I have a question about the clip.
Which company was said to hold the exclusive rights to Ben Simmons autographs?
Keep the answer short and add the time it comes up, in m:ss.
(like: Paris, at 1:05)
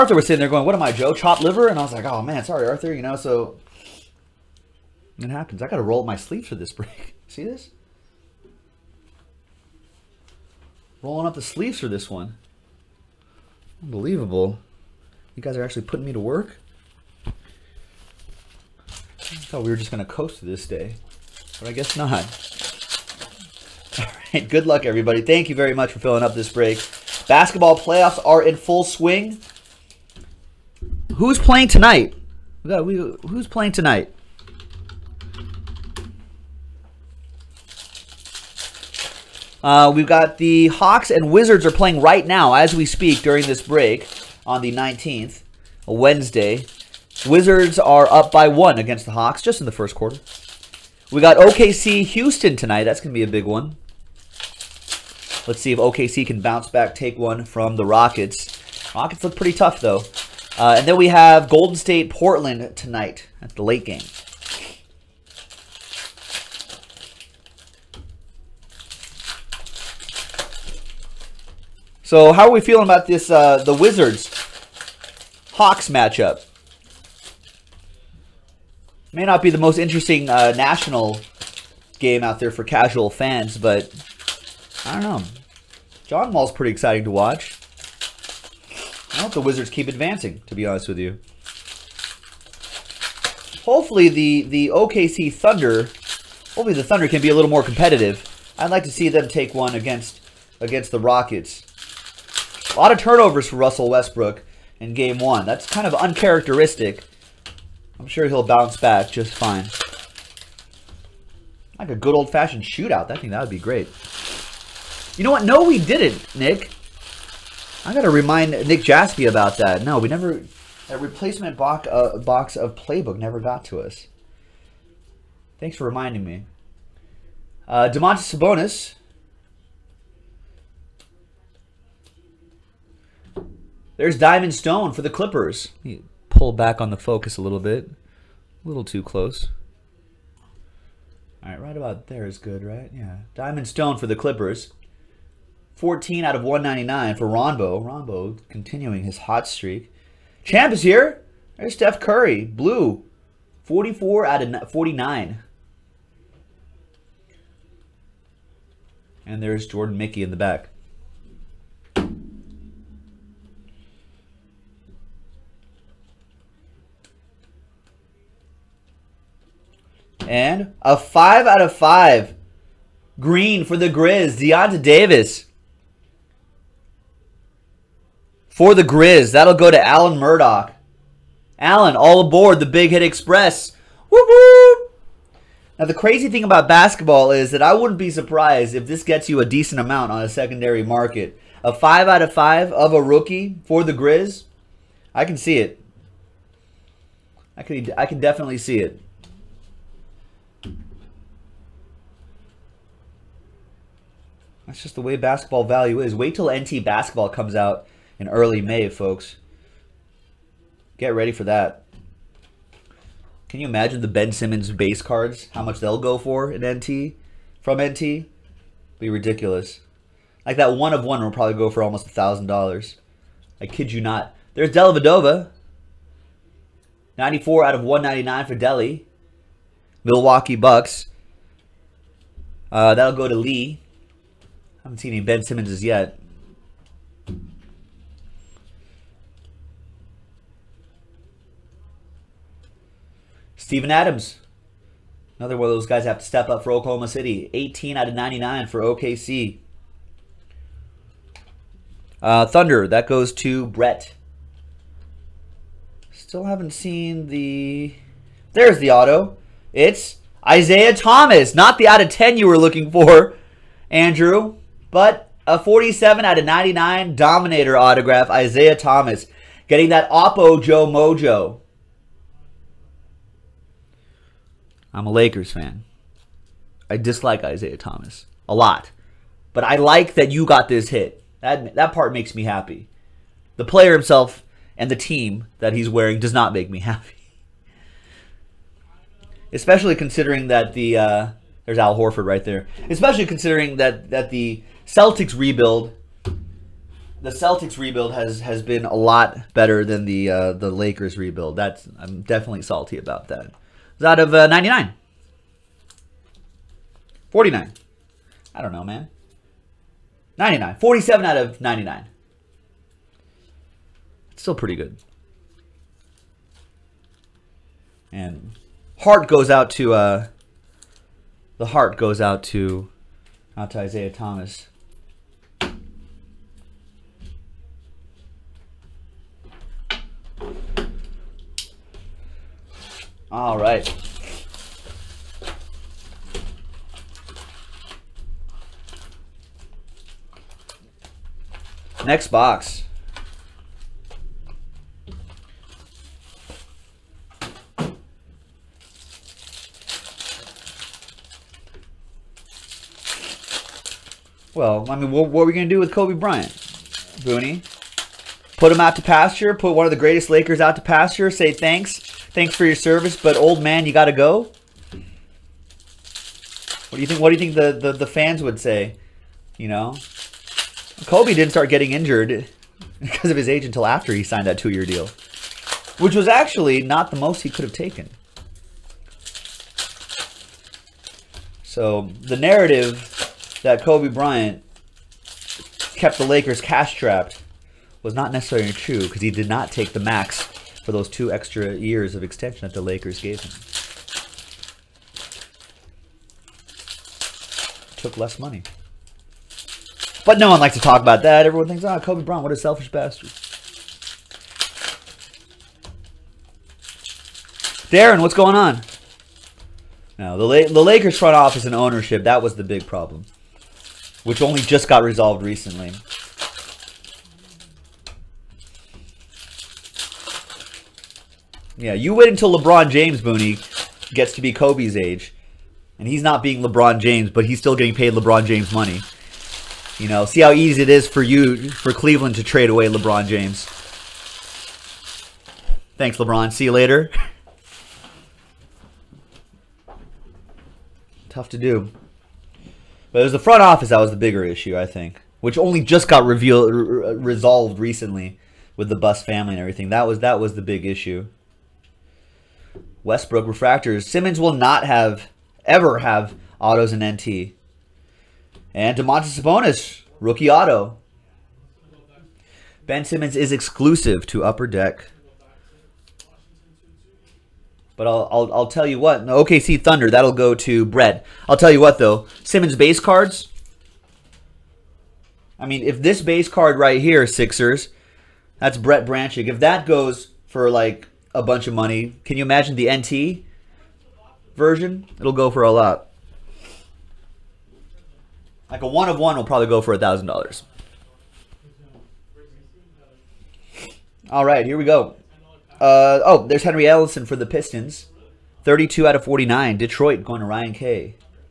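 Upper Deck, at 7:44.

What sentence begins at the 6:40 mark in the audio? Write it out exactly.
But no one likes to talk about that.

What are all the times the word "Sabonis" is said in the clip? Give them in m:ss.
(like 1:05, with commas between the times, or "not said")
2:08, 7:39.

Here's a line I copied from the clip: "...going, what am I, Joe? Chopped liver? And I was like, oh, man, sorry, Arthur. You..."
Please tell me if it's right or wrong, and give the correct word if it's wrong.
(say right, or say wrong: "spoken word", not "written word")
right.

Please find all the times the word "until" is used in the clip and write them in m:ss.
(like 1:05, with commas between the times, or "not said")
6:13, 7:02.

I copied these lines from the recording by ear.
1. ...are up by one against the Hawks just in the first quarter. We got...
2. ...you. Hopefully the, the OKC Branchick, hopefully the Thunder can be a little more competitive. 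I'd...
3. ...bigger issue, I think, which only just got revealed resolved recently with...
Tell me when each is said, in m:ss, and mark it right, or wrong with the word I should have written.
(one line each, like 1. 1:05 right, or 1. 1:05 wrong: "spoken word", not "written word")
1. 0:47 right
2. 1:30 wrong: "Thunder", not "Branchick"
3. 7:24 right.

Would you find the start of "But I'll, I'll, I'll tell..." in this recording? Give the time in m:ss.
7:47.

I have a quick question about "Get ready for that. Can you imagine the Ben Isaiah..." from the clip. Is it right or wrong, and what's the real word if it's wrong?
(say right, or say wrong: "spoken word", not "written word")
wrong: "Simmons", not "Isaiah".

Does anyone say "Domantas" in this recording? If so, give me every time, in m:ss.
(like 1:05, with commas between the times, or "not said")
2:07, 7:38.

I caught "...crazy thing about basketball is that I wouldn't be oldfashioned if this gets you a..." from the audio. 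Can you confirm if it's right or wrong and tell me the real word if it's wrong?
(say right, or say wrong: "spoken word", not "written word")
wrong: "surprised", not "oldfashioned".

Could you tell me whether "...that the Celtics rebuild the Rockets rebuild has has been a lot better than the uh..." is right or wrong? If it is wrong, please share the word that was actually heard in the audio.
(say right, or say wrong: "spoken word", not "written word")
wrong: "Celtics", not "Rockets".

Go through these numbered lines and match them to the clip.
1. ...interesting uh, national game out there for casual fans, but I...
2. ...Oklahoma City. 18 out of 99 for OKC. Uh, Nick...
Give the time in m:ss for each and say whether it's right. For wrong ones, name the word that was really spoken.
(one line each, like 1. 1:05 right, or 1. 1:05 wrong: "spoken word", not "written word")
1. 1:19 right
2. 4:06 wrong: "Thunder", not "Nick".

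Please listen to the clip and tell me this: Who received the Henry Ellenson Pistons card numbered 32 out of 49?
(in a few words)
Ryan K.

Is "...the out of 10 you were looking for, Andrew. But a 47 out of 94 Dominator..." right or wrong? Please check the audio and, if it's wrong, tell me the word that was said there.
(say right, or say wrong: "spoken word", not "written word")
wrong: "99", not "94".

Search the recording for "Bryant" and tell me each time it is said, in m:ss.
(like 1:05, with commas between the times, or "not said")
5:56, 6:24, 6:42.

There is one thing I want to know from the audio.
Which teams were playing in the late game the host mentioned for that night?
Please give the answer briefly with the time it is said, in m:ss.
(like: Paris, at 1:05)
Golden State Portland, at 1:01.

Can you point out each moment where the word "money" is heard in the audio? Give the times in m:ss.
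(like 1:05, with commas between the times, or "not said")
6:38, 7:08, 8:01.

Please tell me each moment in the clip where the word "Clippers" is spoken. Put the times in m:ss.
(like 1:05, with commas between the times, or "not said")
2:15, 2:24.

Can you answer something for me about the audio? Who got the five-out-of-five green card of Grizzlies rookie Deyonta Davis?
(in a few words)
Alan Murdoch.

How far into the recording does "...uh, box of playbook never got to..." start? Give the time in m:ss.
2:01.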